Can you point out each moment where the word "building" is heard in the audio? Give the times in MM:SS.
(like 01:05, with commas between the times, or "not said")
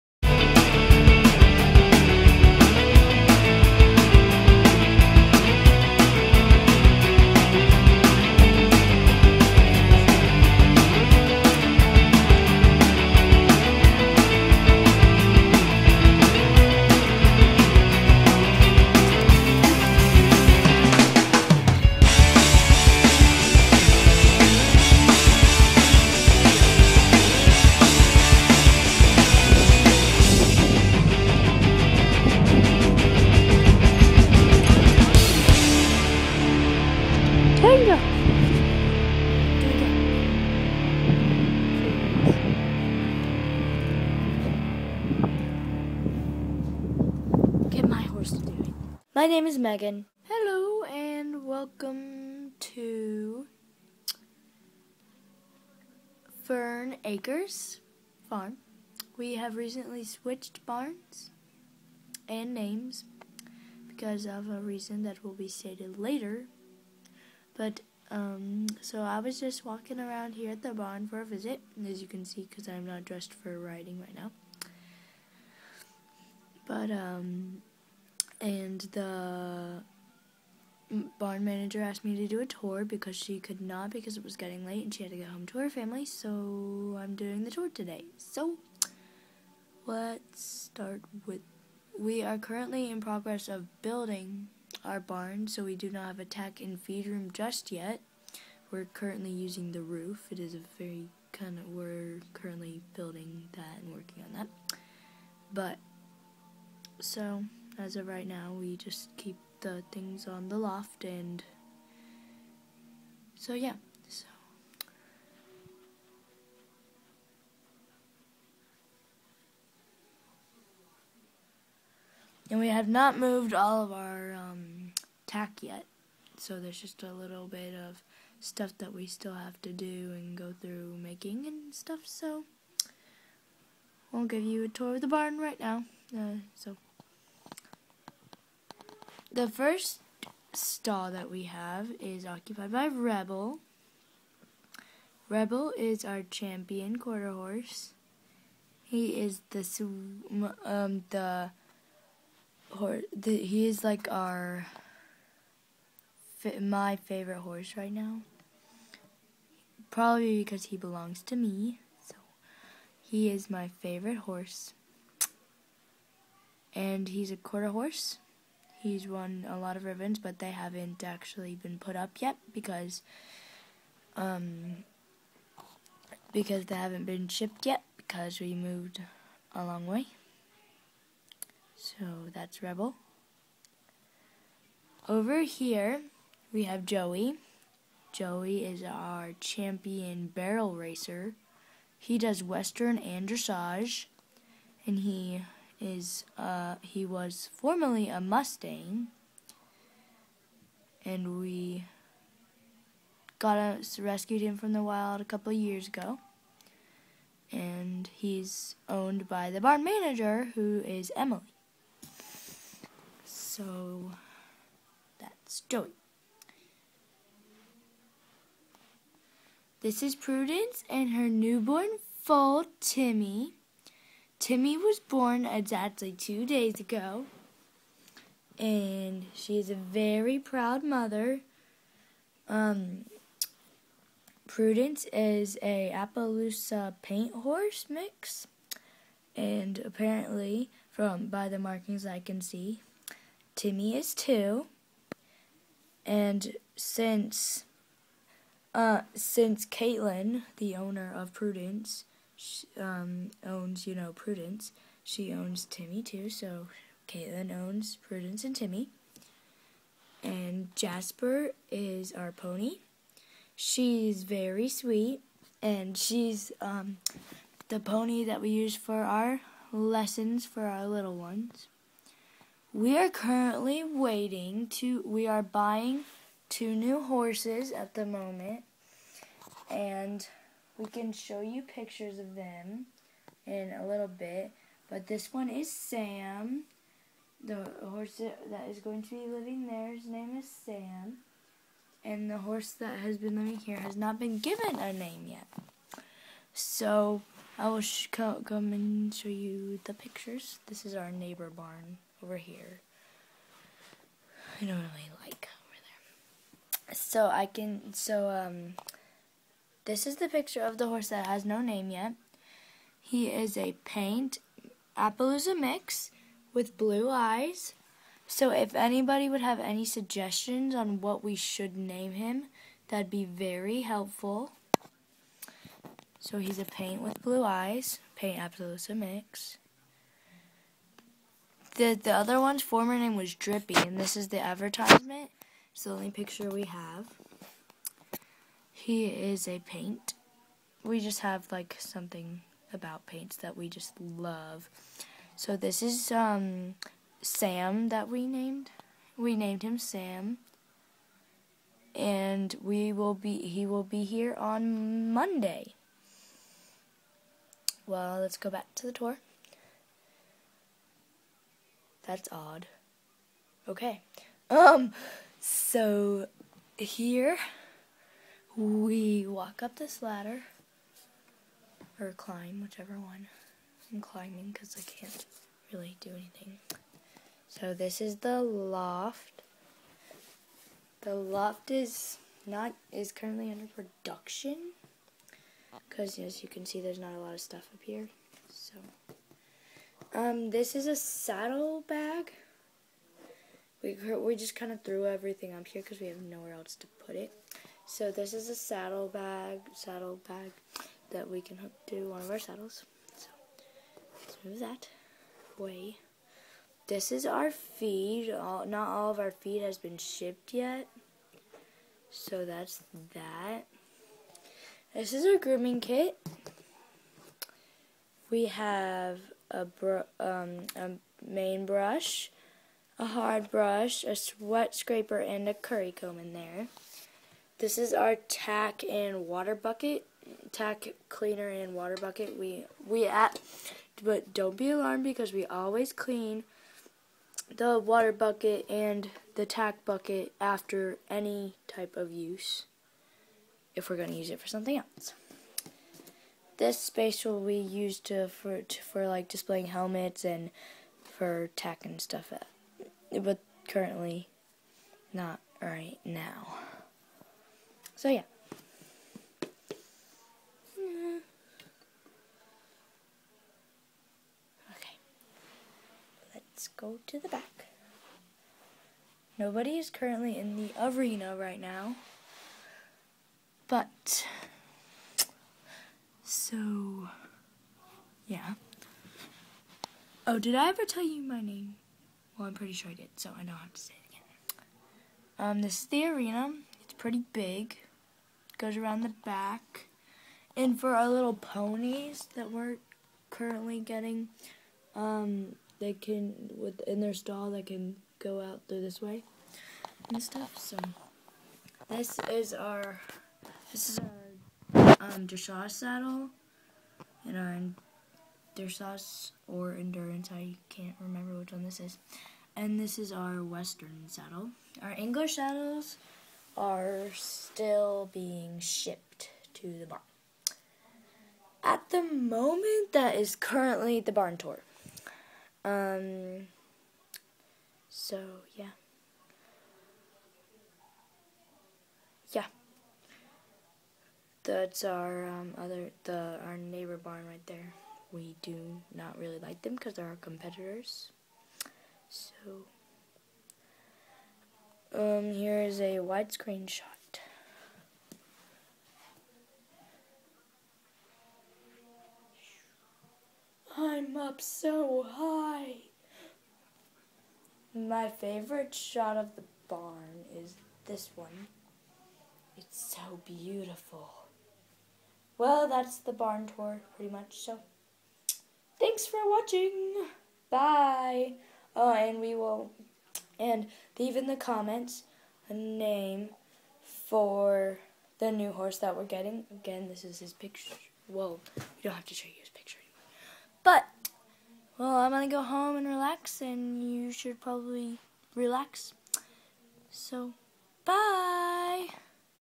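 01:33, 01:42.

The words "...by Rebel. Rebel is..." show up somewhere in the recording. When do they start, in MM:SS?
02:22.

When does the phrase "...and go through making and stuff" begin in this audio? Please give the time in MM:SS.
02:10.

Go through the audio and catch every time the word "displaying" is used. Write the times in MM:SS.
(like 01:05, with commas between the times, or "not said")
07:29.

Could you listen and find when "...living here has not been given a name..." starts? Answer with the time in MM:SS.
04:53.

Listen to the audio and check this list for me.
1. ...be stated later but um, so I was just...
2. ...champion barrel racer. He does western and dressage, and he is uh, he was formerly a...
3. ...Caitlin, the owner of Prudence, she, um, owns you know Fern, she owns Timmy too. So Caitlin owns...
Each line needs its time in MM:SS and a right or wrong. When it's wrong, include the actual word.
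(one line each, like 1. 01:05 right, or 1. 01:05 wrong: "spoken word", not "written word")
1. 01:05 right
2. 03:09 right
3. 04:09 wrong: "Prudence", not "Fern".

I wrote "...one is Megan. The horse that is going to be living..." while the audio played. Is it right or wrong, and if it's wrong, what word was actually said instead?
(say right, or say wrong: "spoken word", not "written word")
wrong: "Sam", not "Megan".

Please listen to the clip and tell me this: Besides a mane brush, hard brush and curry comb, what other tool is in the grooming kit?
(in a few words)
sweat scraper.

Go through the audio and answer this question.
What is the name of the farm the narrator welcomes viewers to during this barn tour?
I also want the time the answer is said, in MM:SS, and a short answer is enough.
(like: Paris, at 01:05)
Fern Acres Farm, at 00:56.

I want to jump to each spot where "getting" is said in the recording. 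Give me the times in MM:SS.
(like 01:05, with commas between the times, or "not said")
01:24, 08:13, 09:39.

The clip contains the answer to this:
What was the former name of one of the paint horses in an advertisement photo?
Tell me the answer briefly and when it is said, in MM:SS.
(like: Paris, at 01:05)
Drippy, at 05:33.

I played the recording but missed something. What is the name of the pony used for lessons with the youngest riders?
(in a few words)
Jasper.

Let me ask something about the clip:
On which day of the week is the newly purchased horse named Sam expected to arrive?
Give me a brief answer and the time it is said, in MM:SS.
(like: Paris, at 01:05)
Monday, at 05:55.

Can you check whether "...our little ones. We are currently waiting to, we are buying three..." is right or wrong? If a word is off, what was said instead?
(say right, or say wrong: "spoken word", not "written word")
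wrong: "two", not "three".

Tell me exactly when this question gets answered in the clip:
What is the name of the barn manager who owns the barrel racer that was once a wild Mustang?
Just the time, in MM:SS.
03:31.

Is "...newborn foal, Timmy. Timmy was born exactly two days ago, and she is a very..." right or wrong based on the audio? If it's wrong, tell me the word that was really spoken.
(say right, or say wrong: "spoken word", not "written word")
right.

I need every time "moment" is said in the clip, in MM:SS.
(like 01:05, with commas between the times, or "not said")
04:38, 08:42.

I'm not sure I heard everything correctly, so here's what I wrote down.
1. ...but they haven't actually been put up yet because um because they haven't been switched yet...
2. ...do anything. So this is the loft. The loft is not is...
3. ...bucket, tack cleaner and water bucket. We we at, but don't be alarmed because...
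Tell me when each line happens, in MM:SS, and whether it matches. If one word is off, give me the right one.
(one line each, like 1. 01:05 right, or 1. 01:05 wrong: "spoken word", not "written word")
1. 02:50 wrong: "shipped", not "switched"
2. 06:16 right
3. 07:09 right.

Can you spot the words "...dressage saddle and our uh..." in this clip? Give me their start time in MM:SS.
08:25.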